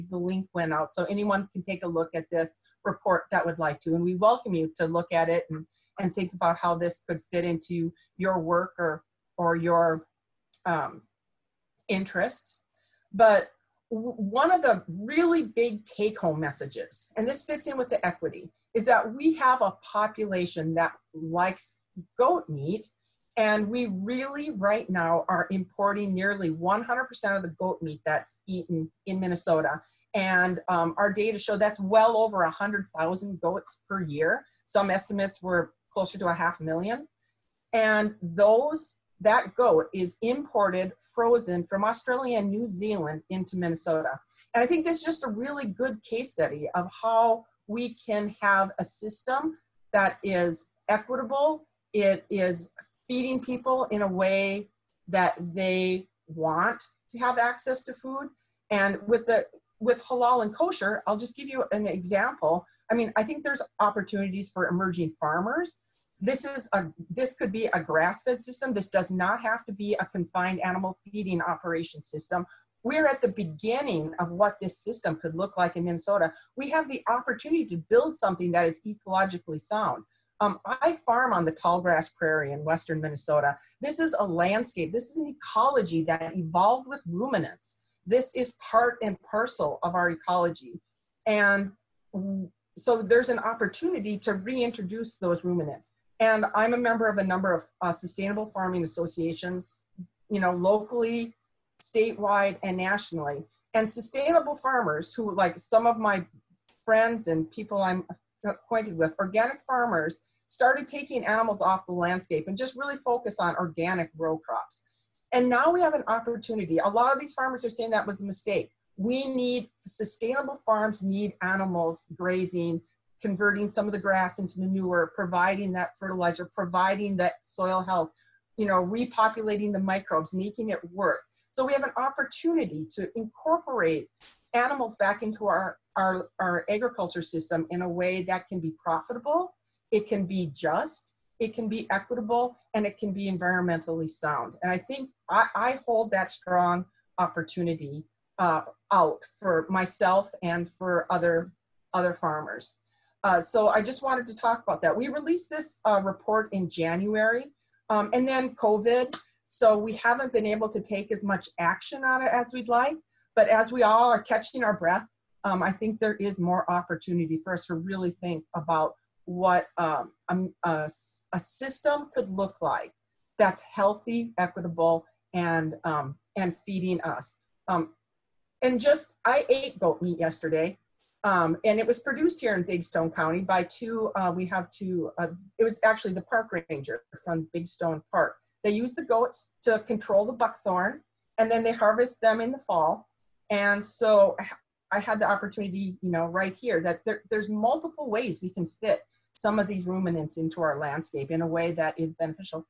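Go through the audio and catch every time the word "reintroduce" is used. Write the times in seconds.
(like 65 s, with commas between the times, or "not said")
94 s.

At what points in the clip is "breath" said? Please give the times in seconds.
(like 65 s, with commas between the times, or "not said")
164 s.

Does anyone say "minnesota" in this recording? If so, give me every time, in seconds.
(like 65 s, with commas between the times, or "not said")
29 s, 43 s, 75 s, 83 s.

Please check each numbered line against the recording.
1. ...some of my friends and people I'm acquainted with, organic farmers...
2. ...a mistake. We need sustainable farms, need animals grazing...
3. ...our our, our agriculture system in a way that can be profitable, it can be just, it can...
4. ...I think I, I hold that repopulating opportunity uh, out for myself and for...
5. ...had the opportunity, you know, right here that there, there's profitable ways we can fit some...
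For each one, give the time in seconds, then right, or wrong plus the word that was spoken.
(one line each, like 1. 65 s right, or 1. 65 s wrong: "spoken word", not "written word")
1. 105 s right
2. 118 s right
3. 135 s right
4. 144 s wrong: "strong", not "repopulating"
5. 195 s wrong: "multiple", not "profitable".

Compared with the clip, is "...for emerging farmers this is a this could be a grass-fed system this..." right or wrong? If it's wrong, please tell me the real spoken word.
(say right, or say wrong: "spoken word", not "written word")
right.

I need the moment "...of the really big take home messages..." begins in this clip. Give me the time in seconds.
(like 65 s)
14 s.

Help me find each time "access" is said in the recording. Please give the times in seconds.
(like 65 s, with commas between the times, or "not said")
57 s.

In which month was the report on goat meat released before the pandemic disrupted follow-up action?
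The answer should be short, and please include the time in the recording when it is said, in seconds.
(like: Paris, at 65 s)
January, at 156 s.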